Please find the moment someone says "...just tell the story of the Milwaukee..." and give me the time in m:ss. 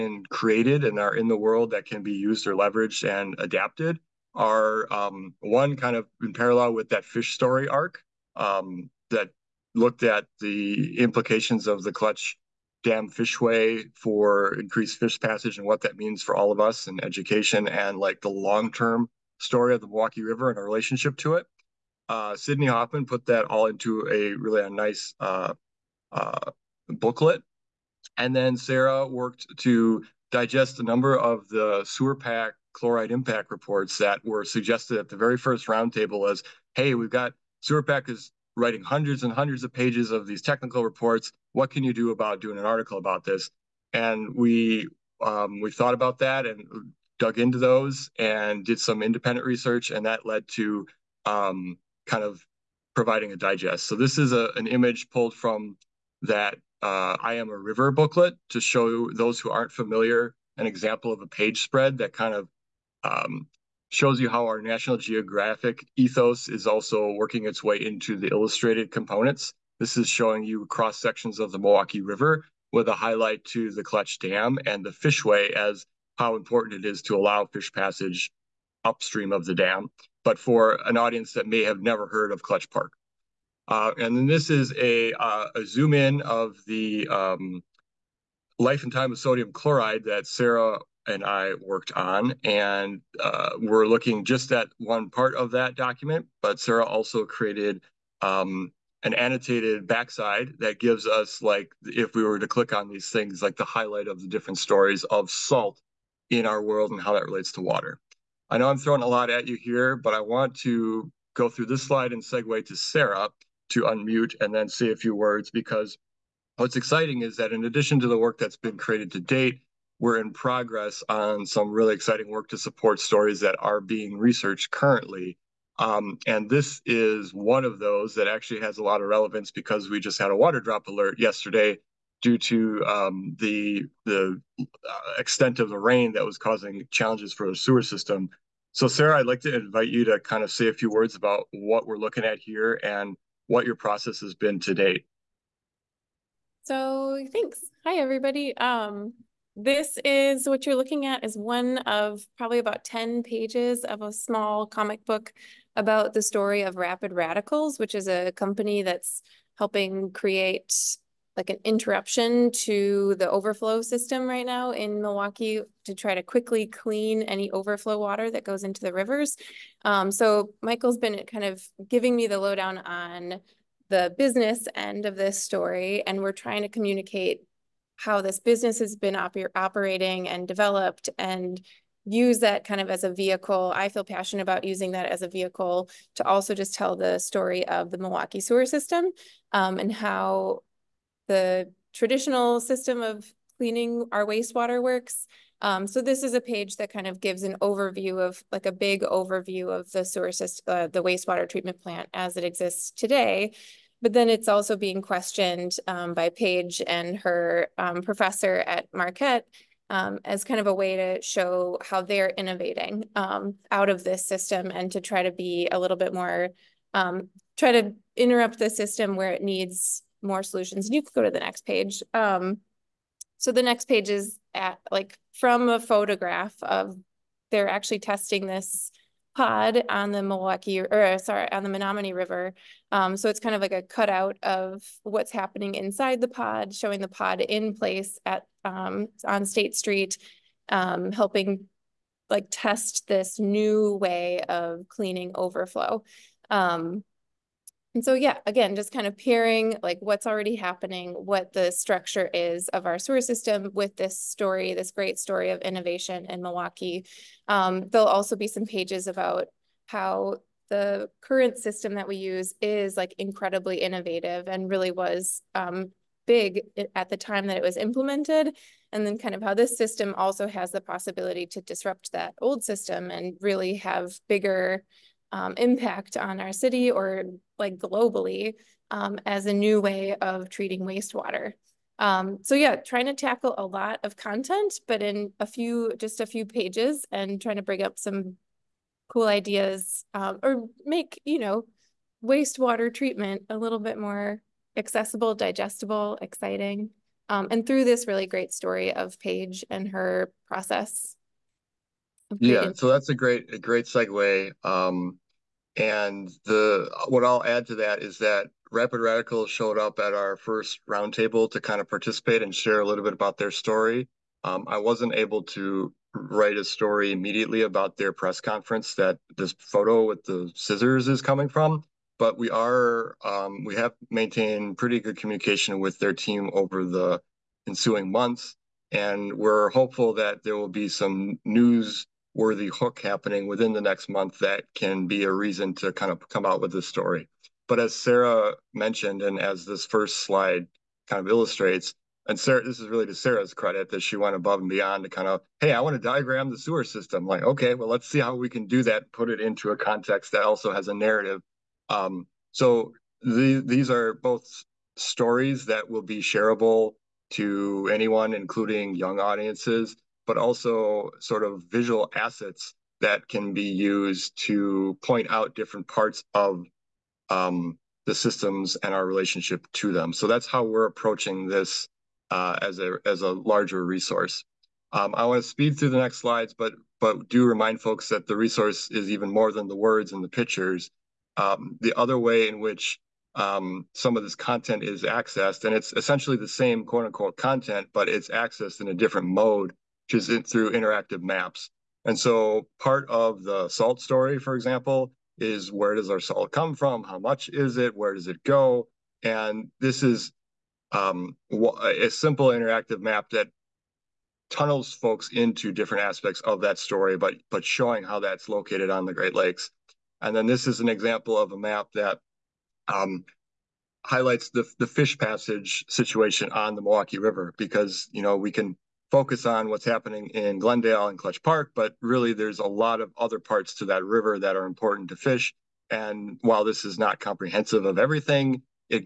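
3:06.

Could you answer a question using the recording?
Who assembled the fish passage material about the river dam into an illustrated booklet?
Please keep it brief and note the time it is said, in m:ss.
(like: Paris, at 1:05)
Sydney Hoffman, at 0:22.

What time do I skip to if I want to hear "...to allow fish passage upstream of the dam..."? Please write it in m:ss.
1:17.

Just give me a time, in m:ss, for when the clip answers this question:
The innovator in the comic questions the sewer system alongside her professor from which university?
3:28.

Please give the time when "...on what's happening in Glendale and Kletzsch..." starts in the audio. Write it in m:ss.
6:59.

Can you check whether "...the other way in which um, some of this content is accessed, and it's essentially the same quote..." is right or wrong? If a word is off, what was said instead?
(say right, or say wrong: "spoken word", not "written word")
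right.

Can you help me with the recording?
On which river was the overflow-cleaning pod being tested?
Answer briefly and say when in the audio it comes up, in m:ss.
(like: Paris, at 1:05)
Menomonee River, at 3:51.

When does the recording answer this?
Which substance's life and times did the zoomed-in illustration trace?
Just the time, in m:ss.
1:29.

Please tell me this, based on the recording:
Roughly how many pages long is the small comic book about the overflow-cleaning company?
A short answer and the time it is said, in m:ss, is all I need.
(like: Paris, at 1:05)
10, at 2:32.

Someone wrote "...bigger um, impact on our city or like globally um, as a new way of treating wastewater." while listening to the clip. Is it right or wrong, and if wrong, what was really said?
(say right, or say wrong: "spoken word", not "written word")
right.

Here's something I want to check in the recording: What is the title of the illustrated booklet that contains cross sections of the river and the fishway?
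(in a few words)
I Am a River.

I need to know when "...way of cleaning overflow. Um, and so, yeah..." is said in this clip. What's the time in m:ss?
4:03.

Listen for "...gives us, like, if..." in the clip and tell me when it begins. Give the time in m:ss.
1:40.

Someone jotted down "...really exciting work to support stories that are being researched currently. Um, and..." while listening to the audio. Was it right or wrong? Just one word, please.
right.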